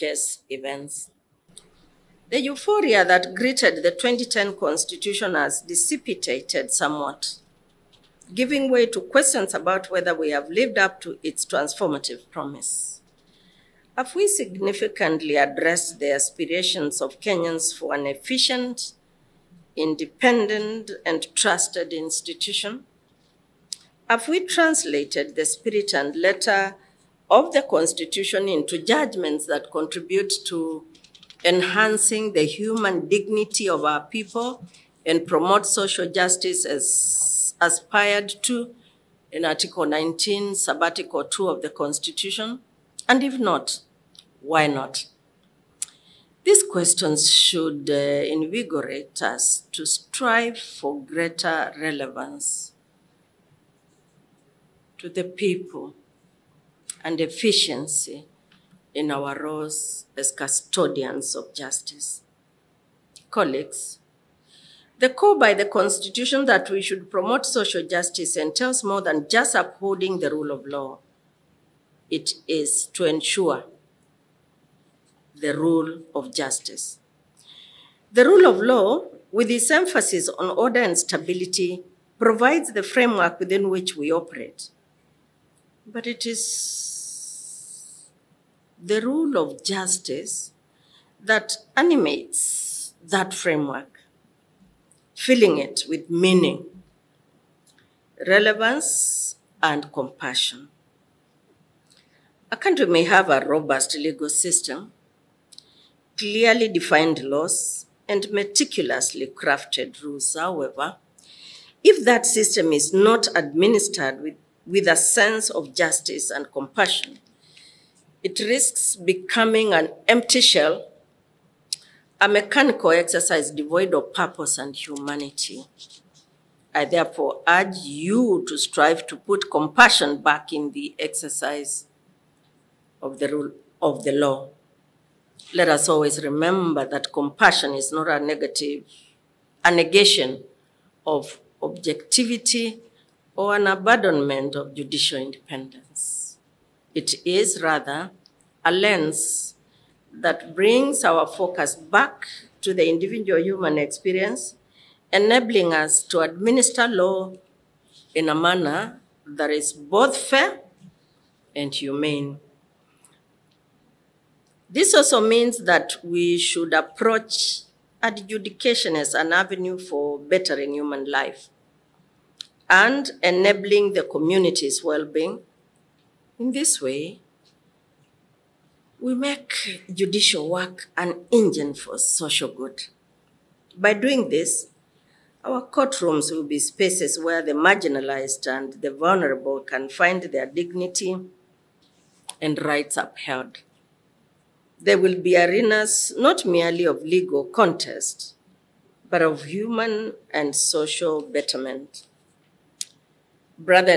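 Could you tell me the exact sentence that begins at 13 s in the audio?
Have we significantly addressed the aspirations of Kenyans for an efficient, independent, and trusted institution?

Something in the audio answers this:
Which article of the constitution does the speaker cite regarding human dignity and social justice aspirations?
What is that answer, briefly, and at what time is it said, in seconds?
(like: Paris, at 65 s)
Article 19, at 39 s.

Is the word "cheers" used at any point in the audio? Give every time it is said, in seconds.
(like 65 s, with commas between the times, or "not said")
not said.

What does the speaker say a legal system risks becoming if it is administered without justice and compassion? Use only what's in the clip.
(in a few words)
an empty shell.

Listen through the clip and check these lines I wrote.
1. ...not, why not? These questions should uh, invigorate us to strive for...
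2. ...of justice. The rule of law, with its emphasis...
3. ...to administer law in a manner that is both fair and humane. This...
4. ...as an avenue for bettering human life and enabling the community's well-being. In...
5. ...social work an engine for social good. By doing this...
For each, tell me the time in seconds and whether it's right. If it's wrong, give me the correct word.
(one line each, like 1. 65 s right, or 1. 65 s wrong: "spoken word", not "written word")
1. 43 s right
2. 76 s right
3. 156 s right
4. 168 s right
5. 179 s wrong: "judicial", not "social".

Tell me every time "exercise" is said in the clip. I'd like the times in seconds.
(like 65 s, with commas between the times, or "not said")
122 s, 130 s.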